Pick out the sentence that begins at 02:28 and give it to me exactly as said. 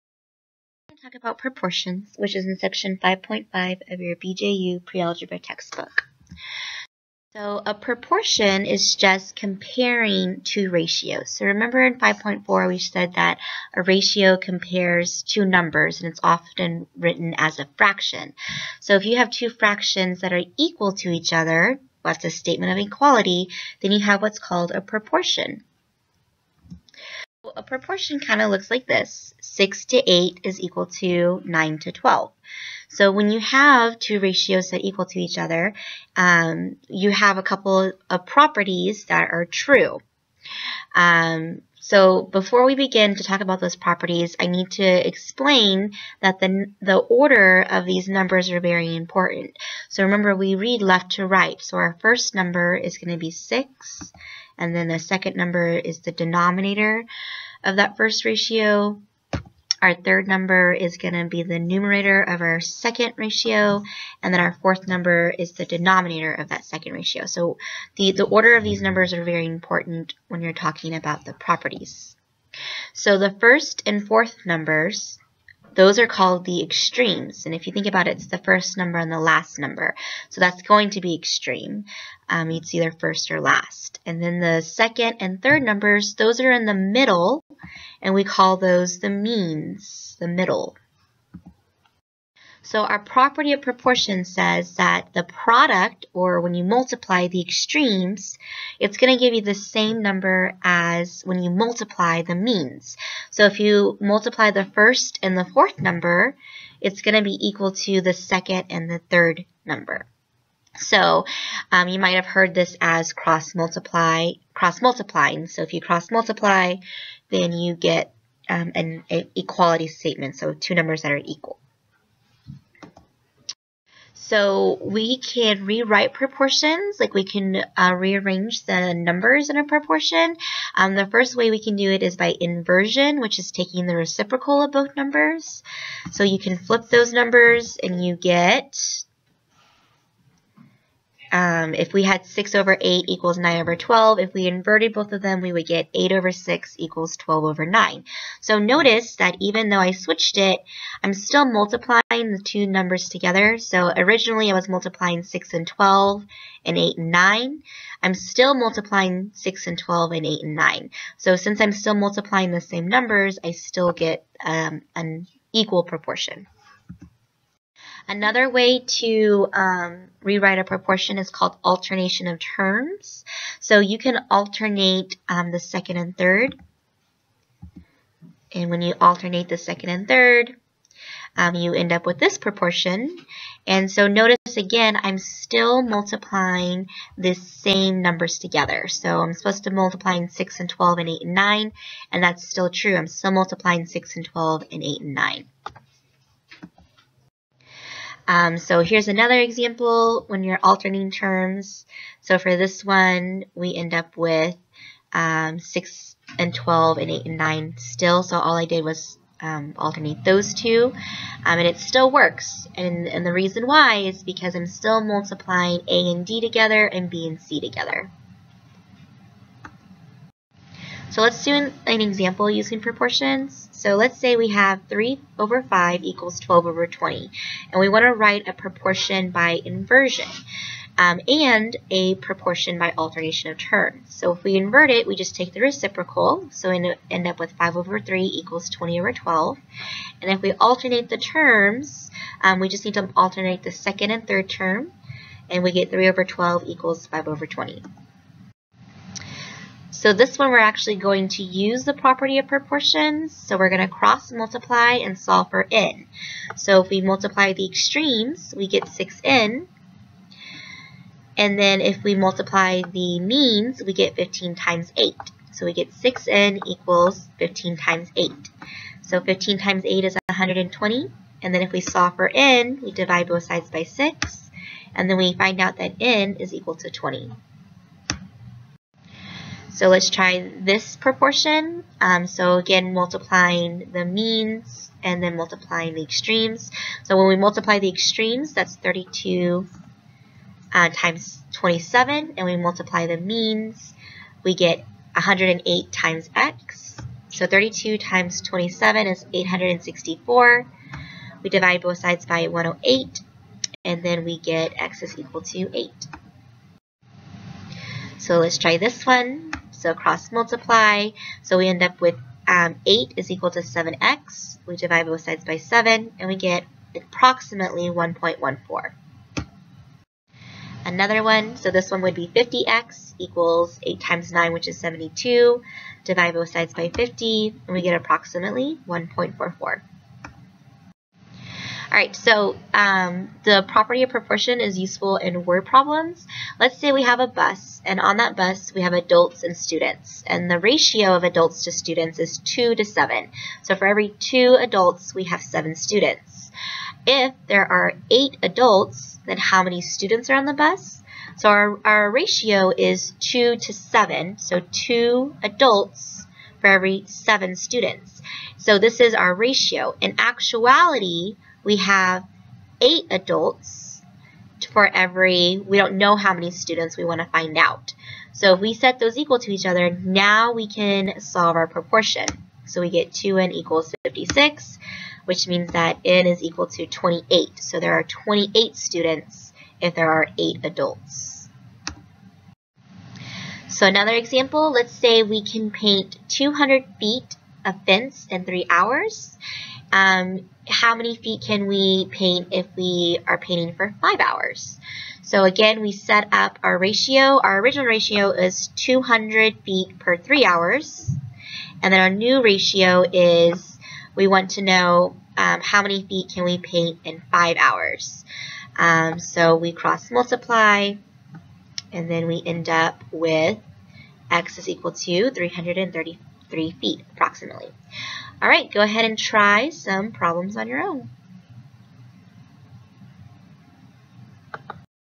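So notice that even though I switched it, I'm still multiplying the two numbers together.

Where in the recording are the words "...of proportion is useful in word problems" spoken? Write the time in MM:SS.
05:34.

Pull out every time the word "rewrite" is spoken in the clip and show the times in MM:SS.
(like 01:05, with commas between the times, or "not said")
02:05, 02:50.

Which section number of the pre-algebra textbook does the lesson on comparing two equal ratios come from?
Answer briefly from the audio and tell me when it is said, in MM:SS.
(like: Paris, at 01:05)
5.5, at 00:02.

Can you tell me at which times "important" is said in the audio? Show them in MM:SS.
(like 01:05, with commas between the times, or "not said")
00:48, 01:09.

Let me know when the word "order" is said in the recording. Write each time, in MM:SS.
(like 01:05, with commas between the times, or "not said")
00:46, 01:08.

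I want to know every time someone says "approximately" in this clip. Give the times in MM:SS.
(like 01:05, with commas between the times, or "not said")
05:16, 05:27, 06:57.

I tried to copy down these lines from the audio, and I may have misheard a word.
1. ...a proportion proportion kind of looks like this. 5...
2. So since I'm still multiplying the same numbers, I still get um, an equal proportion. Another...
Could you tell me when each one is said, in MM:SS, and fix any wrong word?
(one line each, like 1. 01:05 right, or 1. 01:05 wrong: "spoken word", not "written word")
1. 00:24 wrong: "6", not "5"
2. 02:41 right.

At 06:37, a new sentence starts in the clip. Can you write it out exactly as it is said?
Our original ratio is 200 feet per three hours.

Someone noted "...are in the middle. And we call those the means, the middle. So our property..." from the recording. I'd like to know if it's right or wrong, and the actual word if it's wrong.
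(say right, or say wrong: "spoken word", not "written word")
right.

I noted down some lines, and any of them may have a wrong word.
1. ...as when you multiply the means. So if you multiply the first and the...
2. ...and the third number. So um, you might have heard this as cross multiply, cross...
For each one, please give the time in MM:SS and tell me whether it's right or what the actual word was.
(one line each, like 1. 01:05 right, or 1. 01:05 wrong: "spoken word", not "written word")
1. 01:40 right
2. 01:48 right.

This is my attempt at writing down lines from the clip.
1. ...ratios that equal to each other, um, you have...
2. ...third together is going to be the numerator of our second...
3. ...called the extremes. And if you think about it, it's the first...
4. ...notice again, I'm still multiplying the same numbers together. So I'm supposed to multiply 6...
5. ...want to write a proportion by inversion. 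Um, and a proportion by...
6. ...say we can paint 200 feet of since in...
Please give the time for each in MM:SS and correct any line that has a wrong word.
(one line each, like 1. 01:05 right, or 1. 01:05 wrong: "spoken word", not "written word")
1. 00:34 right
2. 00:59 wrong: "number", not "together"
3. 01:16 right
4. 03:04 right
5. 03:47 right
6. 06:24 wrong: "fence", not "since".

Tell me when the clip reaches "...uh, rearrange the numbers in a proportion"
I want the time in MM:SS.
02:07.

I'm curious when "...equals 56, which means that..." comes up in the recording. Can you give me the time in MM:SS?
06:13.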